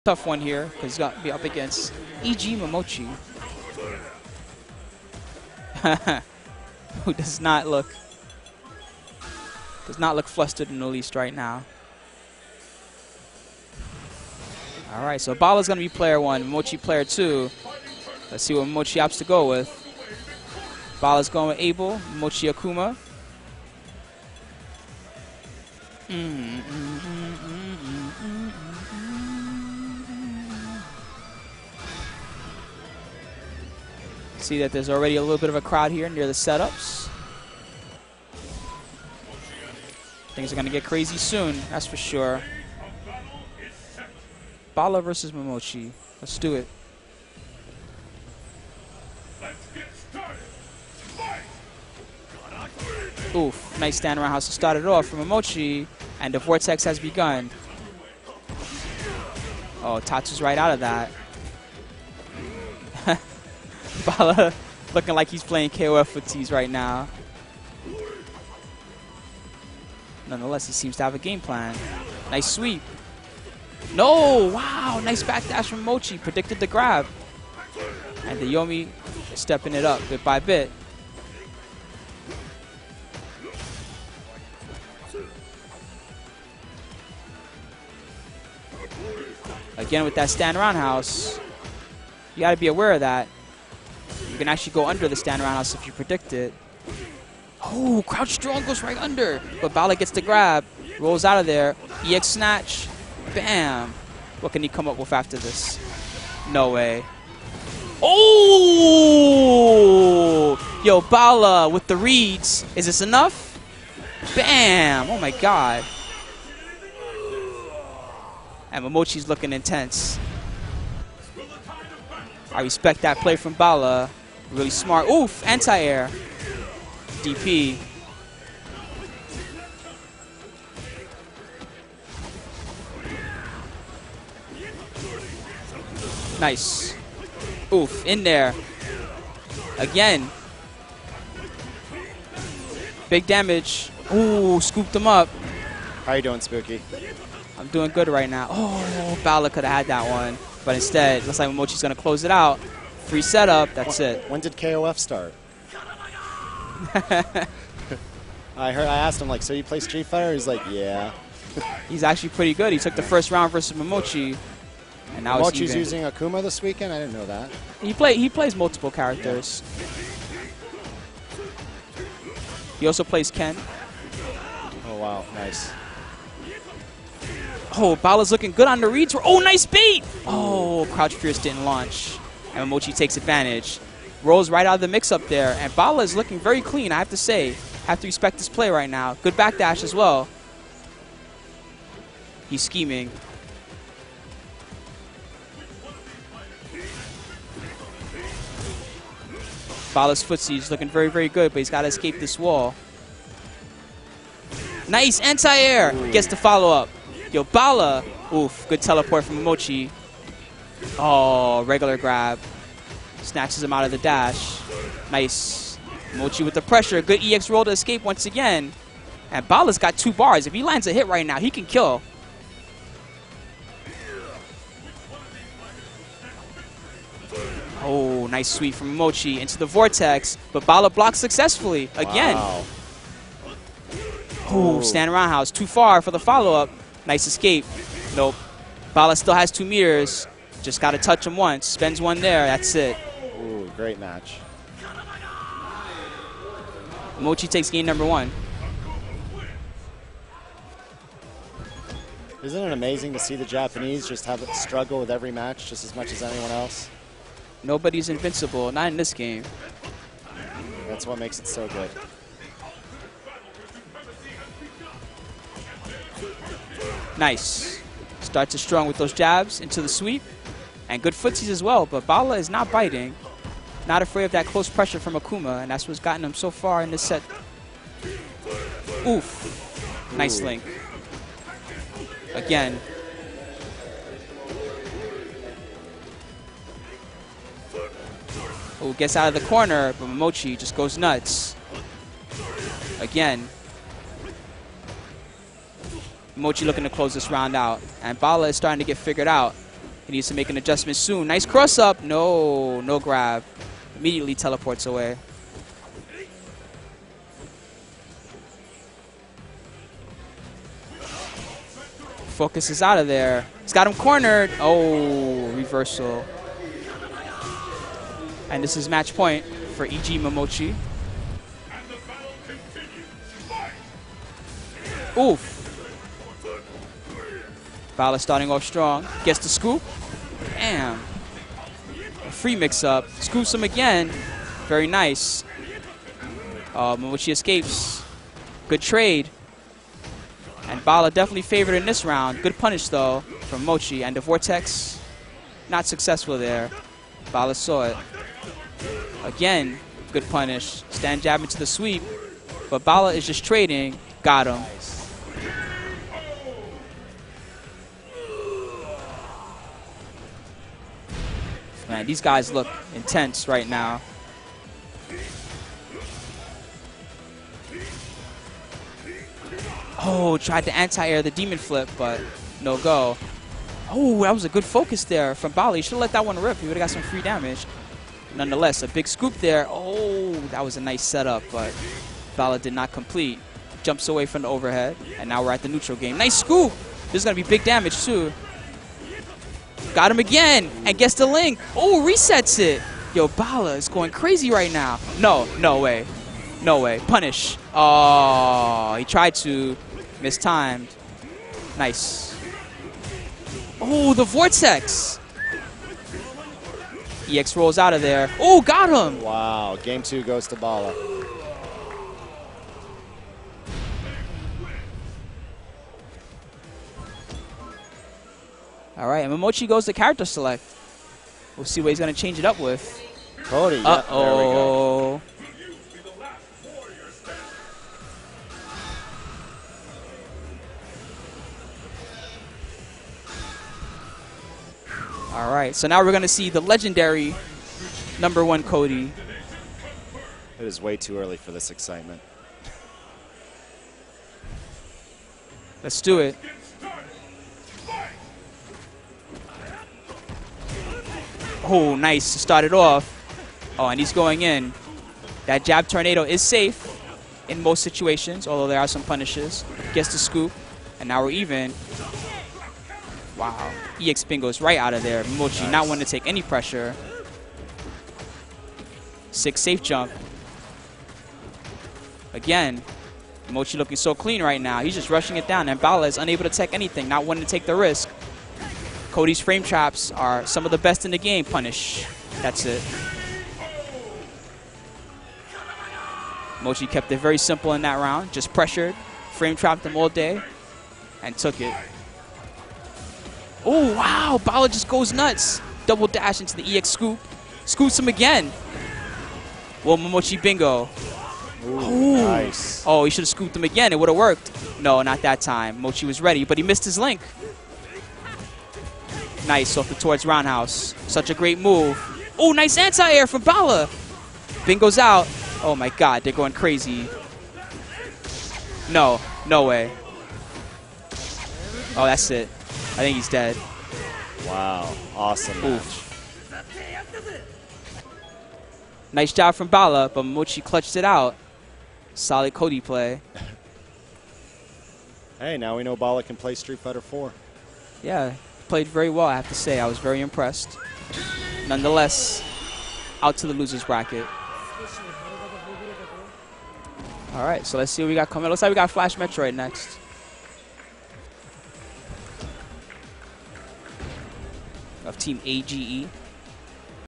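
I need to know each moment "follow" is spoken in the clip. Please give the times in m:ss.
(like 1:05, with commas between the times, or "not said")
3:26, 3:56.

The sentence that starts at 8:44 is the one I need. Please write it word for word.
Wow, awesome Nice job from Bala, but Mochi clutched it out.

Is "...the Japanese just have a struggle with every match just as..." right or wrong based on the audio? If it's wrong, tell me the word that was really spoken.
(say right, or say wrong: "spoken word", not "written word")
right.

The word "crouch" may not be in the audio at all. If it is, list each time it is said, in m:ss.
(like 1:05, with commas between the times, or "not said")
1:38, 3:00.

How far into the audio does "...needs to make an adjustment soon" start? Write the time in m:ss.
5:00.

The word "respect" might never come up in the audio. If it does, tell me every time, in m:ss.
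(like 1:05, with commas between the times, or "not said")
2:02, 3:08.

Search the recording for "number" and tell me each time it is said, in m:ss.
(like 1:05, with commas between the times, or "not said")
4:07, 7:18.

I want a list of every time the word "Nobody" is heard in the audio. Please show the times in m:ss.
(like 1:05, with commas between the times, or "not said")
4:17.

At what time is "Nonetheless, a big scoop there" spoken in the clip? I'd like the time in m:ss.
6:18.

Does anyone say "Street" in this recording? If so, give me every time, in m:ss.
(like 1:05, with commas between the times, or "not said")
2:39, 8:56.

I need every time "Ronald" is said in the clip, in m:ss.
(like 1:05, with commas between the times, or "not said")
not said.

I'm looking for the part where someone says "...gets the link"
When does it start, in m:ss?
6:30.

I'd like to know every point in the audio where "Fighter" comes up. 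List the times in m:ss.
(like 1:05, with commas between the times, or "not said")
2:40, 8:56.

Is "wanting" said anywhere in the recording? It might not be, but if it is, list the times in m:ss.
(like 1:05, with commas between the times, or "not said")
7:45, 7:57.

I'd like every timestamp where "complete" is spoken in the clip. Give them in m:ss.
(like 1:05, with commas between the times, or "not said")
6:22.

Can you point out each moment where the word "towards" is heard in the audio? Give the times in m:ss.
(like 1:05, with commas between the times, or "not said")
8:29.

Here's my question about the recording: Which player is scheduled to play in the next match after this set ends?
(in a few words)
Flash Metroid.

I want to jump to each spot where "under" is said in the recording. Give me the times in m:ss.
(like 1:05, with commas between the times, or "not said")
1:34, 1:38.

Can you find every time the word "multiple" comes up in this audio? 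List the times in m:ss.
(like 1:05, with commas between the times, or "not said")
2:48.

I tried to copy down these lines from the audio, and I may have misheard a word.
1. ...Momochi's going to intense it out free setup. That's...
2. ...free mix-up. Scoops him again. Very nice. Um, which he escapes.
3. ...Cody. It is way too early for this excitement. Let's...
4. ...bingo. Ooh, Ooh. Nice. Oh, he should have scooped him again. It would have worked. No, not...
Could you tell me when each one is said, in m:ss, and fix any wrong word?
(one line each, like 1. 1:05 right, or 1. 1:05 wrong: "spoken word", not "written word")
1. 2:31 wrong: "close", not "intense"
2. 5:32 right
3. 7:18 right
4. 8:20 right.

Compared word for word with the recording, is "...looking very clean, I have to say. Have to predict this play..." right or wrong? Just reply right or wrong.
wrong.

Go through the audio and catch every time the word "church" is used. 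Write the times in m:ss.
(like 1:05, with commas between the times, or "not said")
not said.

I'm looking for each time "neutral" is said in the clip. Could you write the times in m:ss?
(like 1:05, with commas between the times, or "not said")
6:25.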